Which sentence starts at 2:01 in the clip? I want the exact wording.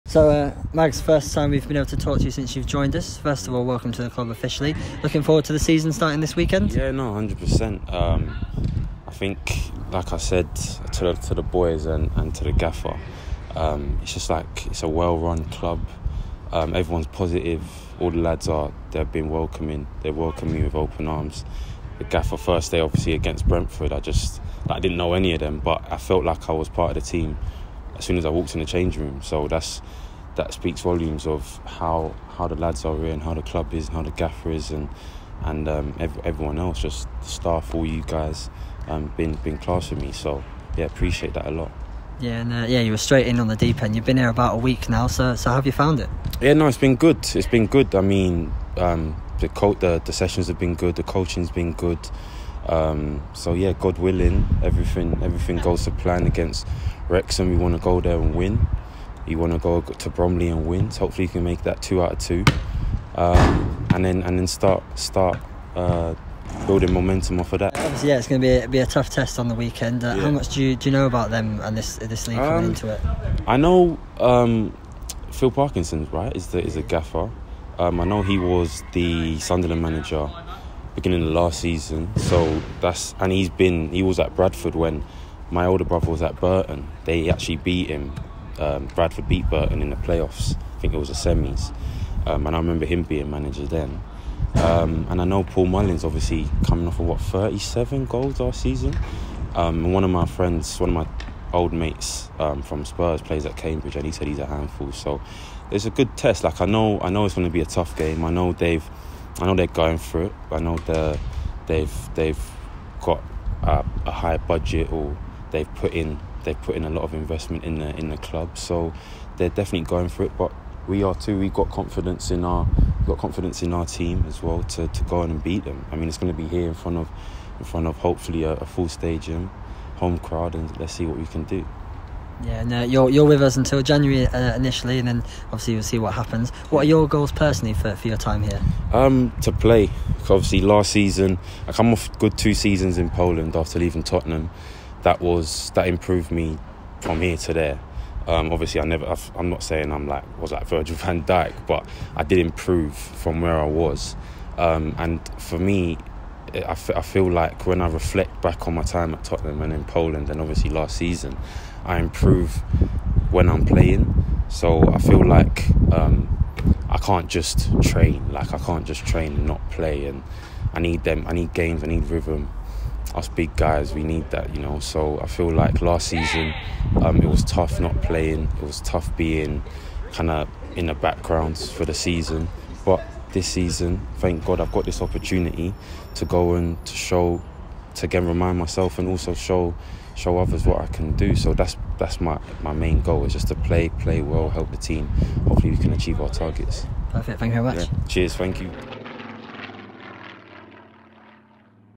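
We got confidence in our got confidence in our team as well to, to go on and beat them.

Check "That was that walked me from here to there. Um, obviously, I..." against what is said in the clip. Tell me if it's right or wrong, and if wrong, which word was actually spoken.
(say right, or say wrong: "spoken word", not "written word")
wrong: "improved", not "walked".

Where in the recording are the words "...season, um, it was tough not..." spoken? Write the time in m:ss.
2:56.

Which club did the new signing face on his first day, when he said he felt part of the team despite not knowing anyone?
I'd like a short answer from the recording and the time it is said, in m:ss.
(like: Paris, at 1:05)
Brentford, at 0:23.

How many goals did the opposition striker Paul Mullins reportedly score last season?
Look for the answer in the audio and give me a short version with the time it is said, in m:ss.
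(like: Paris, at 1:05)
37, at 1:37.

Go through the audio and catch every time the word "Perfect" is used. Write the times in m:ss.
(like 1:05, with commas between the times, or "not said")
3:17.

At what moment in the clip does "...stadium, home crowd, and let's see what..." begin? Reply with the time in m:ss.
2:08.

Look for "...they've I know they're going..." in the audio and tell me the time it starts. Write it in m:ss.
1:48.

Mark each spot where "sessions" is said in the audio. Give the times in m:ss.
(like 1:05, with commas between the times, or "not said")
0:50.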